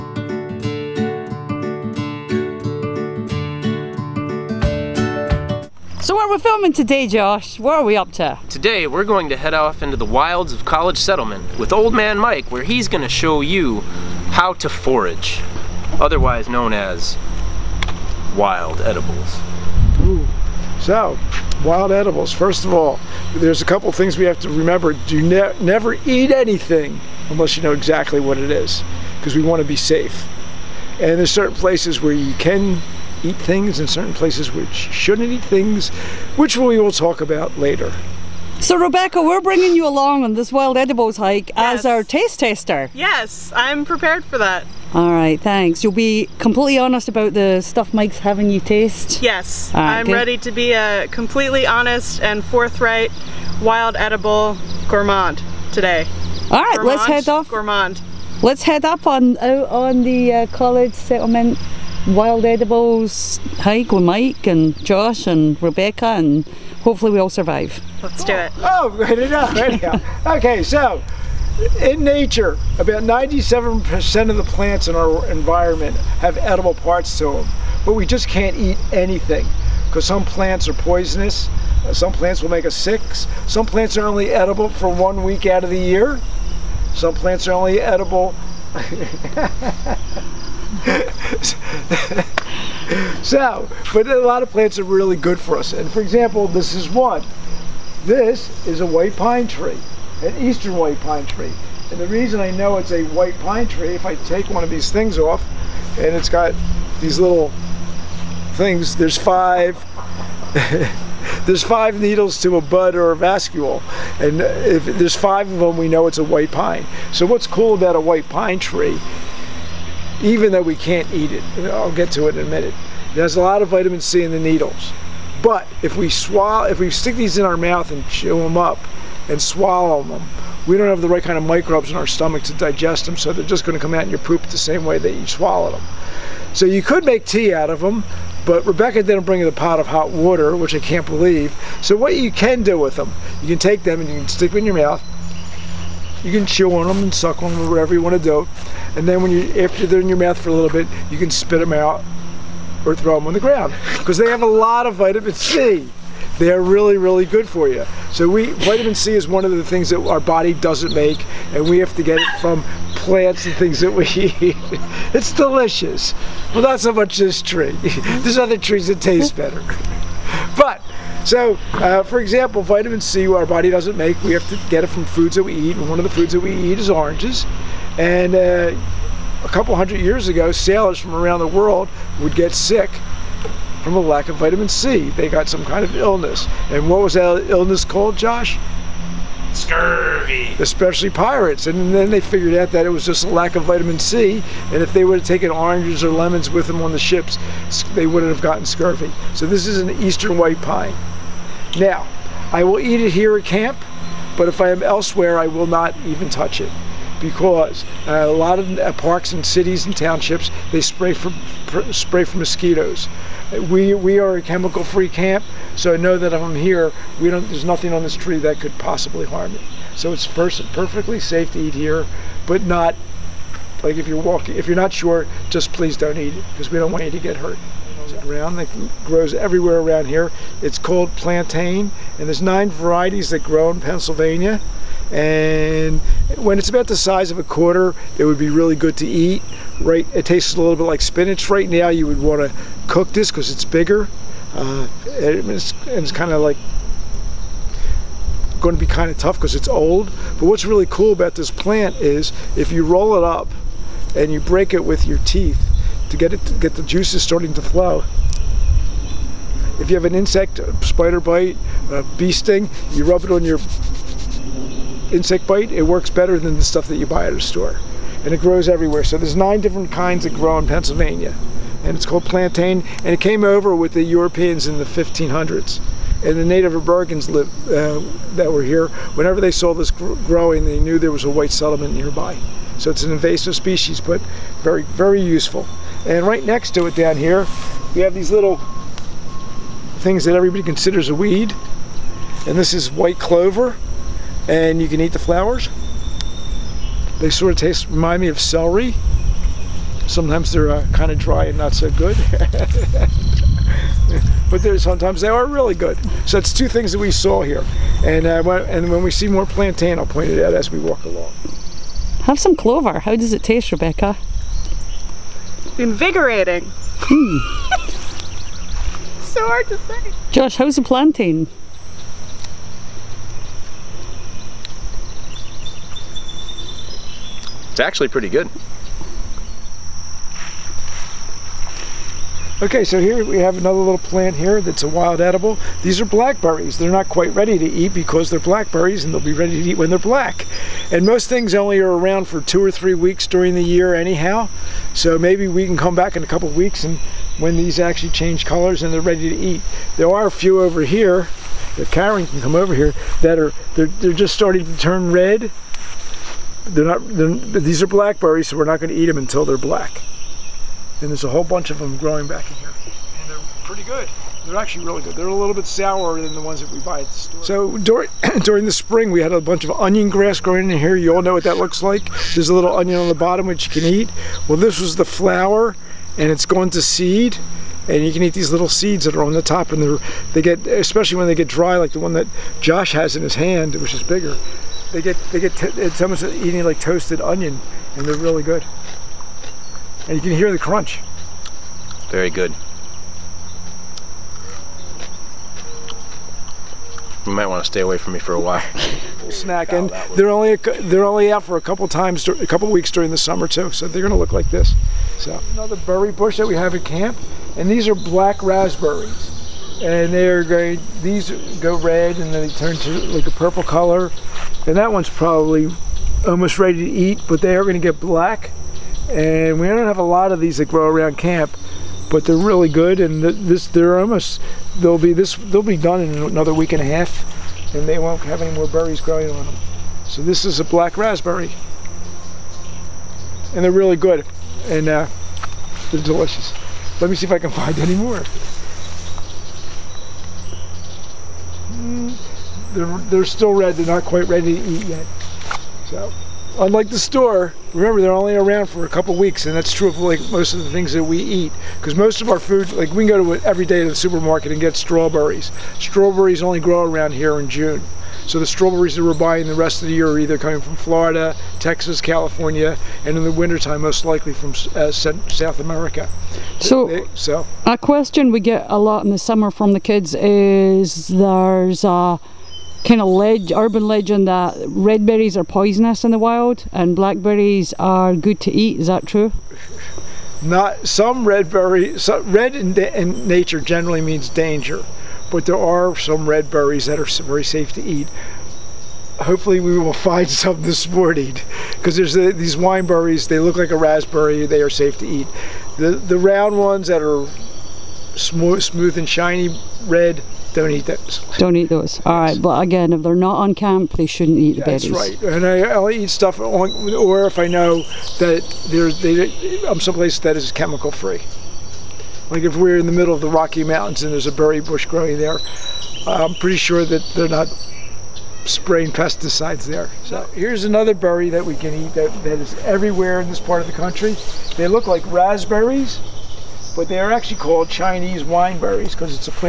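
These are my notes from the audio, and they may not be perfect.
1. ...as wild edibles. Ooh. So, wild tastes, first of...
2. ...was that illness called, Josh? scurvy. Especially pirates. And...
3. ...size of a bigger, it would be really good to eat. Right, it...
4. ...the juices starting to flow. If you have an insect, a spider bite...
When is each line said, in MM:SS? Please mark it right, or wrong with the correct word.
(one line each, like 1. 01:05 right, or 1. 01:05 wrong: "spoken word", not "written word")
1. 00:16 wrong: "edibles", not "tastes"
2. 03:07 right
3. 03:56 wrong: "quarter", not "bigger"
4. 04:16 right.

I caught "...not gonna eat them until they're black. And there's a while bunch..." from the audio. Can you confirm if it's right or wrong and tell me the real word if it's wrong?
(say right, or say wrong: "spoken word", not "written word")
wrong: "whole", not "while".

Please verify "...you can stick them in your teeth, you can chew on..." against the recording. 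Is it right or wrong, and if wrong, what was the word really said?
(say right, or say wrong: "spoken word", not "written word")
wrong: "mouth", not "teeth".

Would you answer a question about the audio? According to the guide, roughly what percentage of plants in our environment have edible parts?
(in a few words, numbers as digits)
97%.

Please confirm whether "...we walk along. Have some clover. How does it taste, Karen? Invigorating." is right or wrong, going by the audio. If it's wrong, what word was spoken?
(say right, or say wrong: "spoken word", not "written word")
wrong: "Rebecca", not "Karen".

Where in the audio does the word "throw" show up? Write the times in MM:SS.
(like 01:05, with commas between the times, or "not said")
02:32.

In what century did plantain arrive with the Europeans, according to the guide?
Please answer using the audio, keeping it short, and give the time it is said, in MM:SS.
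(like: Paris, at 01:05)
1500s, at 04:34.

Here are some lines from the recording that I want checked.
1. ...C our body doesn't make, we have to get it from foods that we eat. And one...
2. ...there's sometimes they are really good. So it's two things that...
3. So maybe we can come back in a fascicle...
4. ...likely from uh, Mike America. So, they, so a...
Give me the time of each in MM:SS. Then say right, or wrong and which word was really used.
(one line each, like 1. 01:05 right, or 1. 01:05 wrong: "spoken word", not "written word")
1. 02:53 right
2. 05:04 right
3. 05:44 wrong: "couple", not "fascicle"
4. 07:44 wrong: "South", not "Mike".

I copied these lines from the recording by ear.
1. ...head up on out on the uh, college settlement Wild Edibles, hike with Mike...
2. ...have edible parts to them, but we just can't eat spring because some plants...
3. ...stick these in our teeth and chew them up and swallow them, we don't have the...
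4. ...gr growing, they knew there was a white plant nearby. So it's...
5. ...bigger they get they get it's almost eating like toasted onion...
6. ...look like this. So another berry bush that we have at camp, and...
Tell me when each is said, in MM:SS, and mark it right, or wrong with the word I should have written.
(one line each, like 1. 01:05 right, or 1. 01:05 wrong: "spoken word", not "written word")
1. 00:58 right
2. 01:16 wrong: "anything", not "spring"
3. 02:06 wrong: "mouth", not "teeth"
4. 04:39 wrong: "settlement", not "plant"
5. 06:24 right
6. 06:44 right.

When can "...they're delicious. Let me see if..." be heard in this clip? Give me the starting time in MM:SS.
07:15.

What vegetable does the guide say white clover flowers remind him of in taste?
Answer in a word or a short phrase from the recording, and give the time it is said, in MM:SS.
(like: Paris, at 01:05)
Celery, at 04:58.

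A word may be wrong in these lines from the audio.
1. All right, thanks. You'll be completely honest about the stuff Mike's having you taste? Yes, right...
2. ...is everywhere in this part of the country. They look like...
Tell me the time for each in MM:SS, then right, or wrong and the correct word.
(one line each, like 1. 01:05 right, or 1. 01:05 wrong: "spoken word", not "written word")
1. 00:44 right
2. 08:42 right.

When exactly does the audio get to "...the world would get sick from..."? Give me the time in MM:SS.
03:01.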